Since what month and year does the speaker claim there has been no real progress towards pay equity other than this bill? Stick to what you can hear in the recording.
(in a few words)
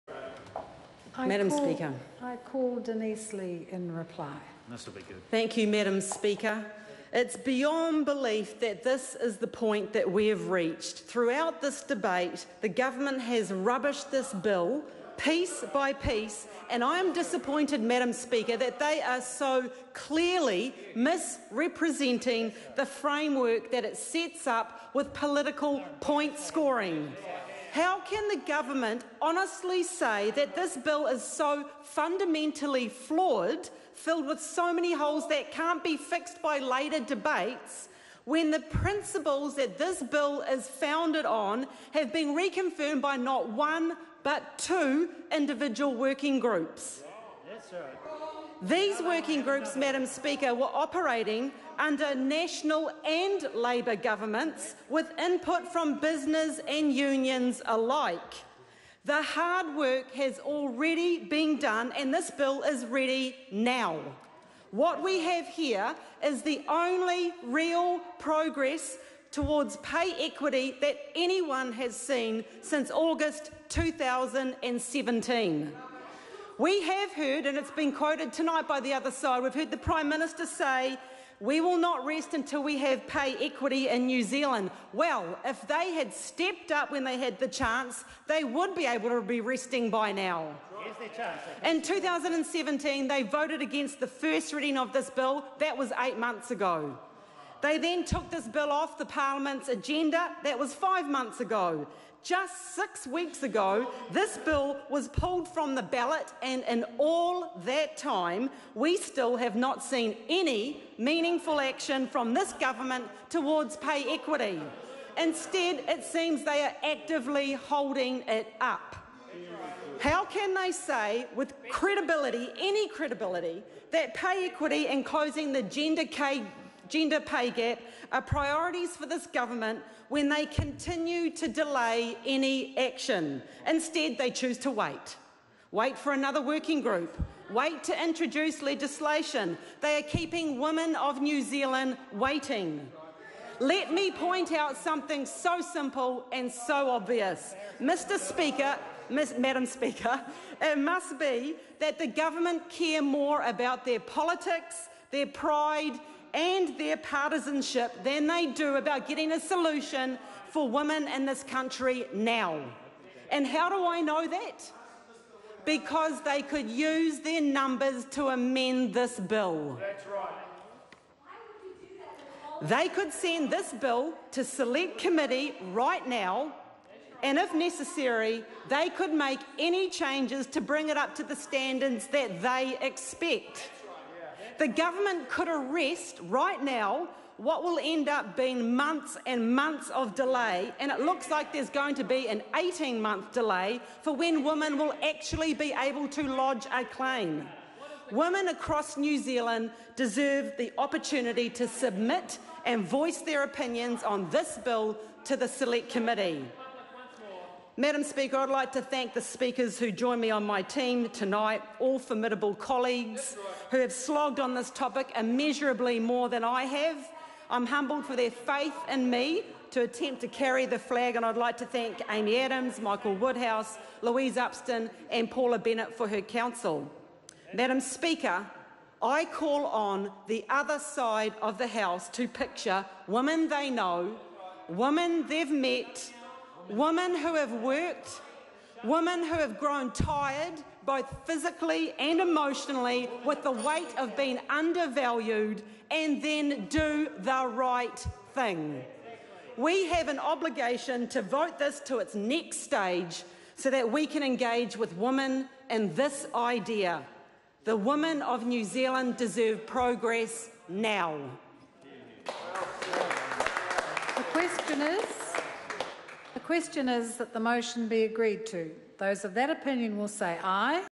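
August 2017.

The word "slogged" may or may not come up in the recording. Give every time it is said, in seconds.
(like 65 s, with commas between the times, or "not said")
213 s.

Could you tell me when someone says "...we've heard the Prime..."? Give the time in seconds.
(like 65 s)
79 s.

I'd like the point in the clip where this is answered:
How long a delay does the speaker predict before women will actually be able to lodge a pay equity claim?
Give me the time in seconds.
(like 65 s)
192 s.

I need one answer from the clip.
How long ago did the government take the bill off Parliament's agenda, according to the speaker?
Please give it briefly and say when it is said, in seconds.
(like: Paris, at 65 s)
5 months, at 100 s.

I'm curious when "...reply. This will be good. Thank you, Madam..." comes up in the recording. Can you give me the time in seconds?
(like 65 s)
3 s.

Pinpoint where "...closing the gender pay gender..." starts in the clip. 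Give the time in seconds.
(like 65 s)
125 s.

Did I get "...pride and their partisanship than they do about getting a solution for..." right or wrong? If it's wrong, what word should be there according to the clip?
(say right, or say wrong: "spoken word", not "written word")
right.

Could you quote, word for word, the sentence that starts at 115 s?
Instead, it seems they are actively holding it up.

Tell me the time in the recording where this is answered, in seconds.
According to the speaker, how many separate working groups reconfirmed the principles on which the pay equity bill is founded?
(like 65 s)
44 s.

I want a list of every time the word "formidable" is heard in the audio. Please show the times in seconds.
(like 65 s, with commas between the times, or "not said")
211 s.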